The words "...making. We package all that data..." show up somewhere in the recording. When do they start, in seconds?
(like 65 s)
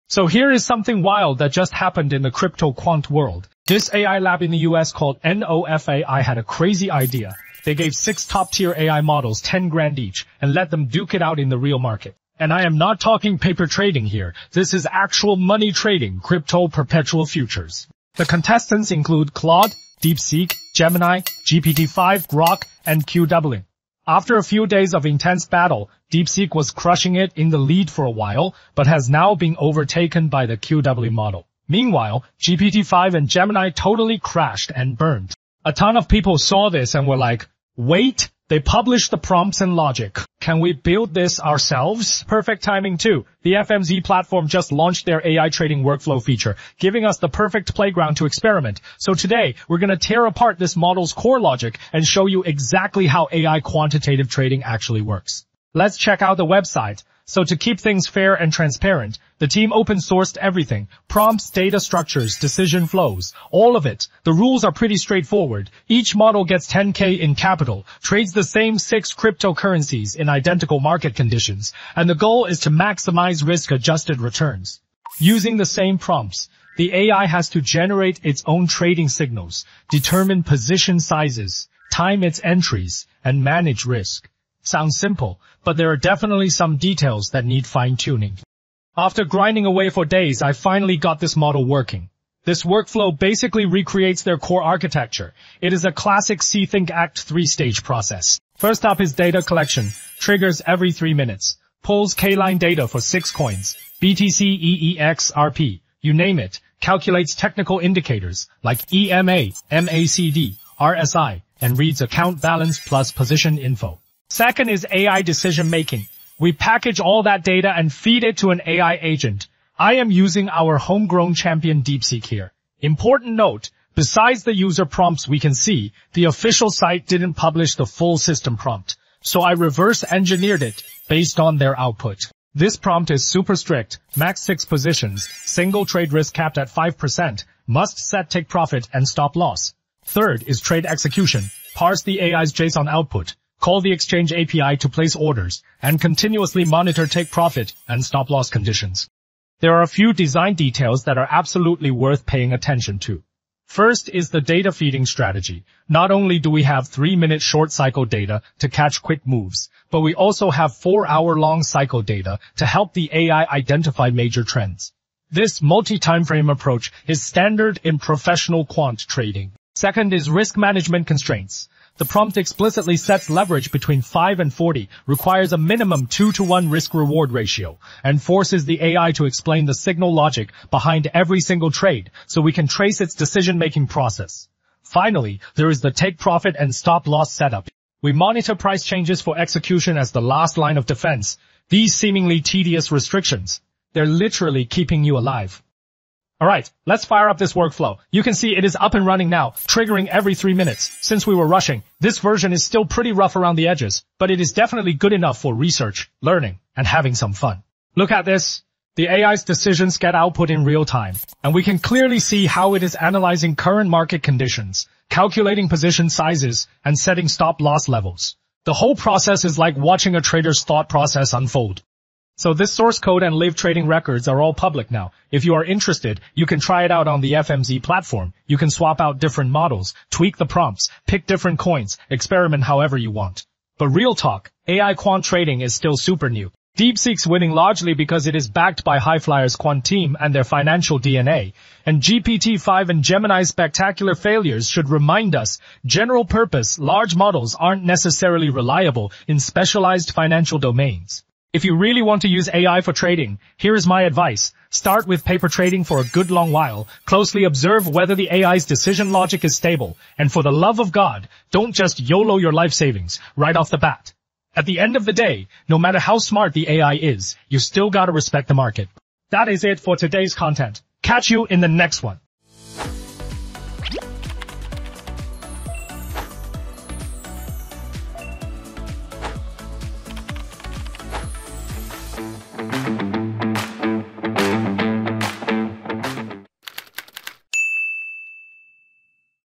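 115 s.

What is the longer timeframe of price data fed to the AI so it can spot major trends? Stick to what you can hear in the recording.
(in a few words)
four-hour.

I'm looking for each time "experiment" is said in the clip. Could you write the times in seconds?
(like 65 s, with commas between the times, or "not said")
48 s, 232 s.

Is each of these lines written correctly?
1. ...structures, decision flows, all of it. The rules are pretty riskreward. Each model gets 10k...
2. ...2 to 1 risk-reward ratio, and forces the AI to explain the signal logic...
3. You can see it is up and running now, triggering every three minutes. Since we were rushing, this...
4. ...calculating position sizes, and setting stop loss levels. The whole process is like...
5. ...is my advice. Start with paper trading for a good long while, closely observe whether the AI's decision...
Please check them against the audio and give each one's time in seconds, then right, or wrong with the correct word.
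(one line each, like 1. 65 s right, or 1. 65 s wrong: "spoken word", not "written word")
1. 61 s wrong: "straightforward", not "riskreward"
2. 176 s right
3. 198 s right
4. 215 s right
5. 253 s right.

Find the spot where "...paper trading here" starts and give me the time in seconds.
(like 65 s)
13 s.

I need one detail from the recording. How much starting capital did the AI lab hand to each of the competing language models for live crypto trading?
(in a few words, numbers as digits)
10 grand.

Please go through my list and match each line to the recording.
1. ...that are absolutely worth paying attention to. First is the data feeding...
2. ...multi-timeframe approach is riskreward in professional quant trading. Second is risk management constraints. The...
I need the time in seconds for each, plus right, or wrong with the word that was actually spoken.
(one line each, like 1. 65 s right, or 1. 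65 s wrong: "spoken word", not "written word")
1. 151 s right
2. 165 s wrong: "standard", not "riskreward".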